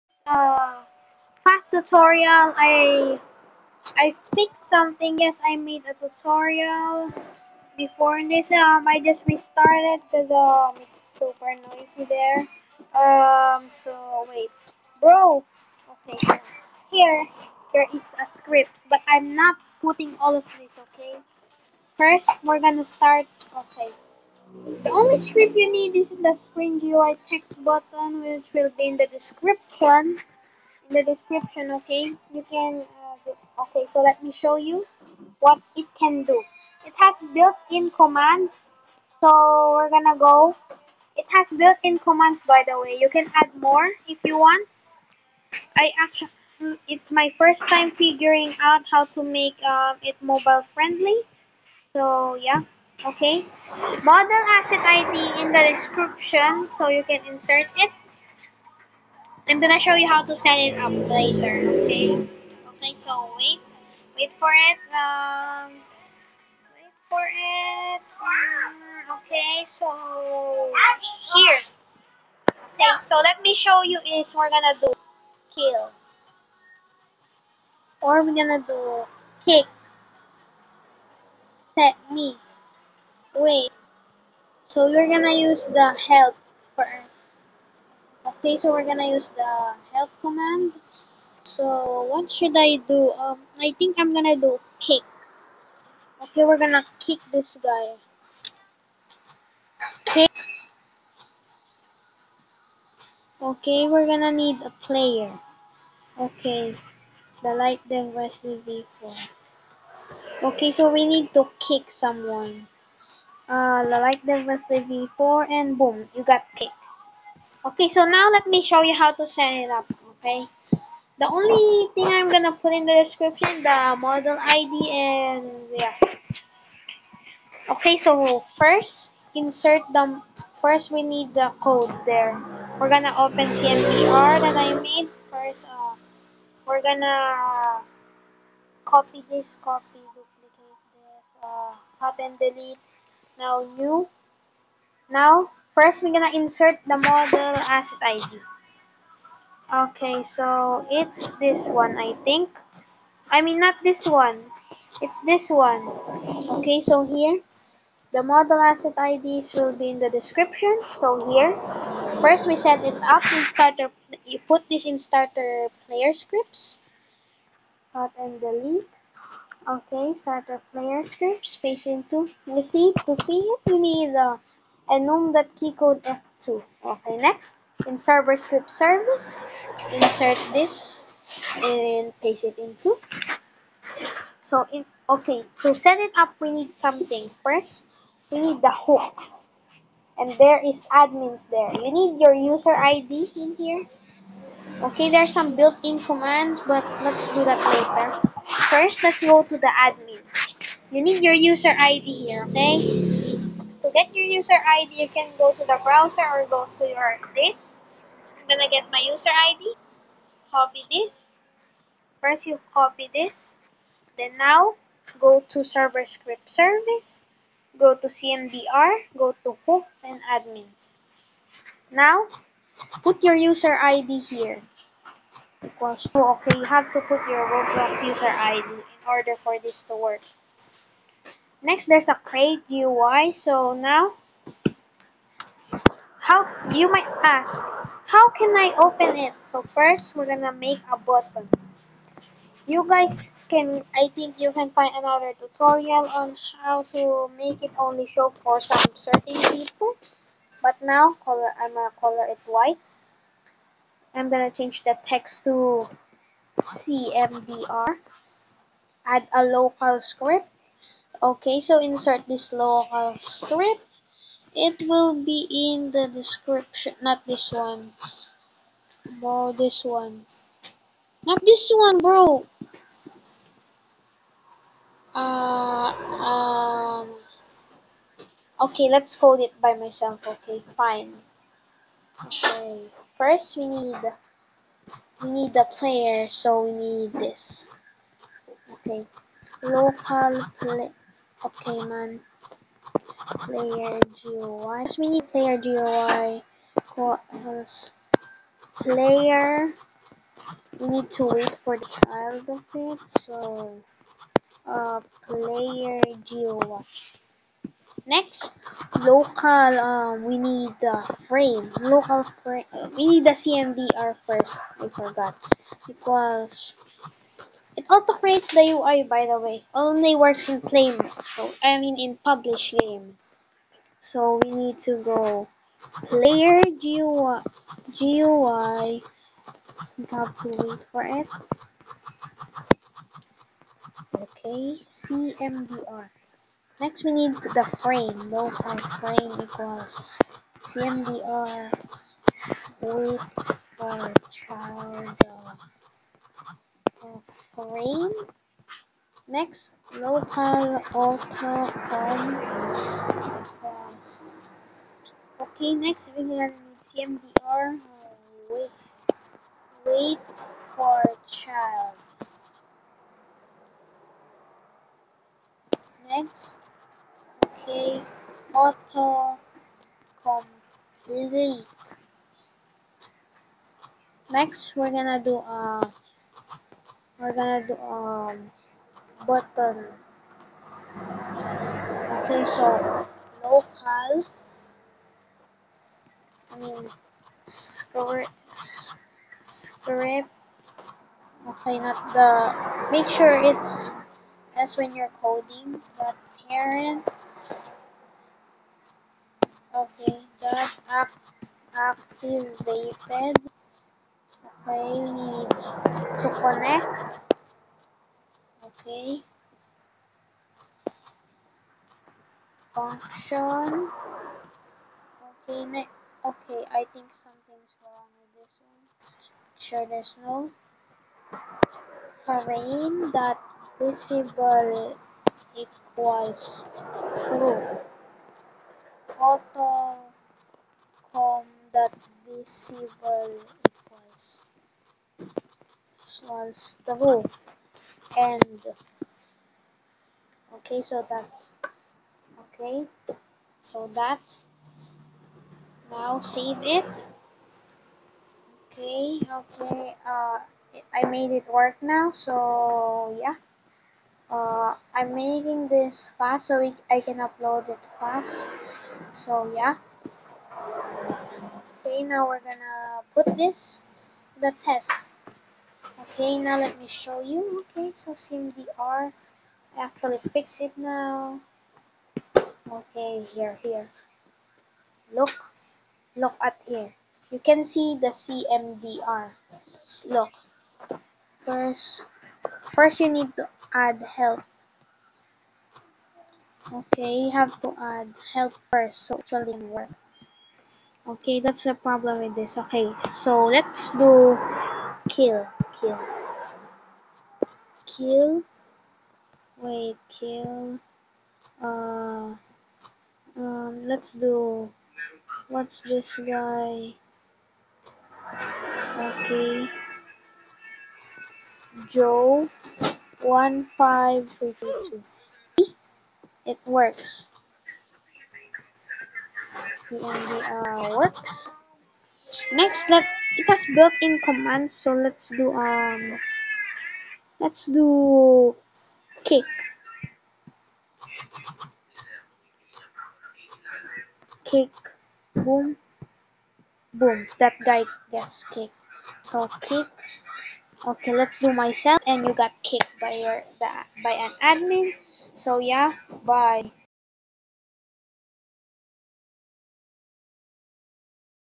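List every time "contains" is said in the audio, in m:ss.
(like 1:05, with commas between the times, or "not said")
not said.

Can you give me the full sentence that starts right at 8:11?
Okay, that's the problem with this.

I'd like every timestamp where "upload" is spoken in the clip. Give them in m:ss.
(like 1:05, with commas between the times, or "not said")
7:37.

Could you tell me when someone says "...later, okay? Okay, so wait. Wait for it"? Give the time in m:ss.
1:01.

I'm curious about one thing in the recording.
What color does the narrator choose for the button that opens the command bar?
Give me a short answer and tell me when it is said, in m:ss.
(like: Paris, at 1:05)
white, at 4:12.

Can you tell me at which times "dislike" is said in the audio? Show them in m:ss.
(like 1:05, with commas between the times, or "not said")
not said.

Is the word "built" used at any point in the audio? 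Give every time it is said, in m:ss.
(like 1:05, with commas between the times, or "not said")
0:37, 0:41, 3:15, 8:43.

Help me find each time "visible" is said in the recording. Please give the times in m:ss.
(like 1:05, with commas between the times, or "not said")
7:03, 7:12.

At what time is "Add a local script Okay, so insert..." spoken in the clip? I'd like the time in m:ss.
4:19.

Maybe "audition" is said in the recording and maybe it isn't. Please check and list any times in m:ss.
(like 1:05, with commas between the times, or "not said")
not said.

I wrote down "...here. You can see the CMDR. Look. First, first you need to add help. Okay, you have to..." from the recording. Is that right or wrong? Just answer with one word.
right.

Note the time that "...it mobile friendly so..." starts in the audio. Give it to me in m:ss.
0:50.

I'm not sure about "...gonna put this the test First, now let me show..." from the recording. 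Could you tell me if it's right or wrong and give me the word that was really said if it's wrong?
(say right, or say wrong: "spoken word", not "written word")
wrong: "Okay", not "First".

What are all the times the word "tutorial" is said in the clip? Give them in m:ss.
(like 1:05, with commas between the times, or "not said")
0:01, 0:05, 4:05.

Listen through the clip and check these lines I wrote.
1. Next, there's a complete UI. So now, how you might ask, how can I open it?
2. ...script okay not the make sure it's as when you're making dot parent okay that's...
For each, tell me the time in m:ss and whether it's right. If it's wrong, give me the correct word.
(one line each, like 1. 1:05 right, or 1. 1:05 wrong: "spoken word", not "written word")
1. 3:51 wrong: "crate", not "complete"
2. 6:29 wrong: "coding", not "making".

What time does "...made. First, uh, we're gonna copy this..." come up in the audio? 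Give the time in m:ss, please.
2:14.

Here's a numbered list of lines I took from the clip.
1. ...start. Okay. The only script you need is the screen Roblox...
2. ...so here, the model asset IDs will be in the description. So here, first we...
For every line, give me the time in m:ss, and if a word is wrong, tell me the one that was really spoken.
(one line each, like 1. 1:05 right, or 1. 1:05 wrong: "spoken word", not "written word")
1. 0:22 wrong: "GUI", not "Roblox"
2. 2:36 right.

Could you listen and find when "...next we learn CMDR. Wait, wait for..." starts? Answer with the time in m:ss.
5:55.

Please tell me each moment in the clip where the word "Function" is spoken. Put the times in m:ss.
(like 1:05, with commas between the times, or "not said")
6:52.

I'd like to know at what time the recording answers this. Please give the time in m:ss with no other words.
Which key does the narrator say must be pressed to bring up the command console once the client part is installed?
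2:56.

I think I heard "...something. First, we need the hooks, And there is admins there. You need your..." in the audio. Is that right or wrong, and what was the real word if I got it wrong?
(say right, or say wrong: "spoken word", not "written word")
right.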